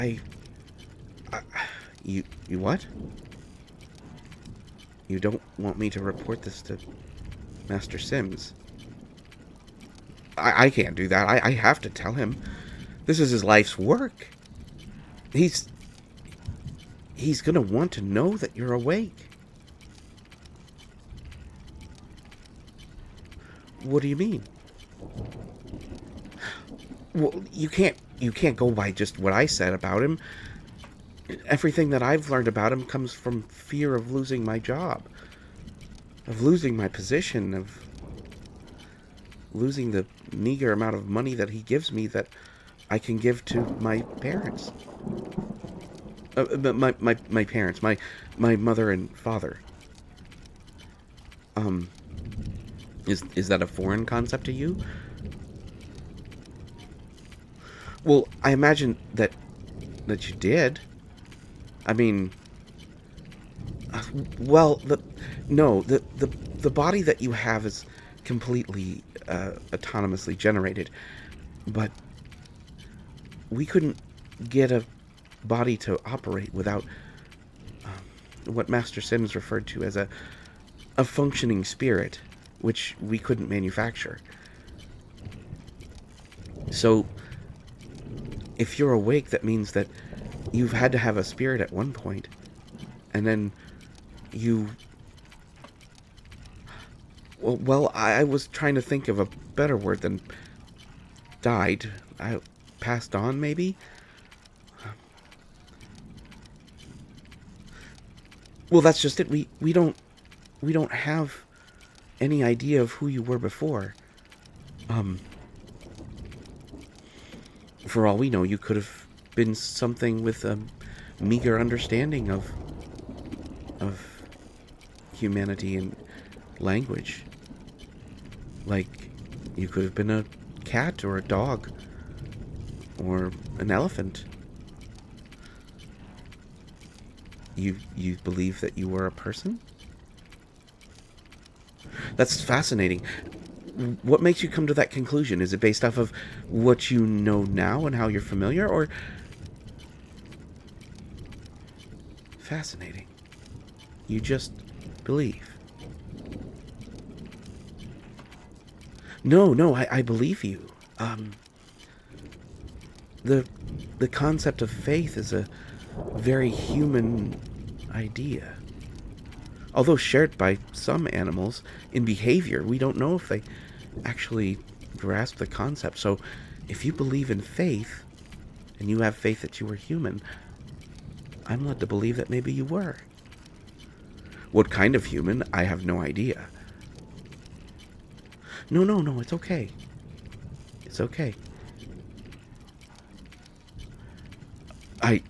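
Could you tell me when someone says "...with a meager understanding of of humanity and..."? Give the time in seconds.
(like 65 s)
120 s.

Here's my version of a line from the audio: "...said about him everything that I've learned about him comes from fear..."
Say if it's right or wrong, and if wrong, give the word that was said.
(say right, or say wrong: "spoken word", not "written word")
right.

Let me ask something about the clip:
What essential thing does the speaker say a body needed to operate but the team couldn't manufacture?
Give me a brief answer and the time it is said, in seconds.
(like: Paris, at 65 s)
a functioning spirit, at 81 s.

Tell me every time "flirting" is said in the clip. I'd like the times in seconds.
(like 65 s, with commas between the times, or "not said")
not said.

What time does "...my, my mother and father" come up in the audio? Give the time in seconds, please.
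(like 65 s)
47 s.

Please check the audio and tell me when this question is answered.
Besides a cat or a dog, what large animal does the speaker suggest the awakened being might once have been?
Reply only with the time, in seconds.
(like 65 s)
133 s.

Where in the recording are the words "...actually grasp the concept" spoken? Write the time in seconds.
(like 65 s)
174 s.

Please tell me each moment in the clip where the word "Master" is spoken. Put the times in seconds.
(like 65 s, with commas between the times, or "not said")
7 s, 78 s.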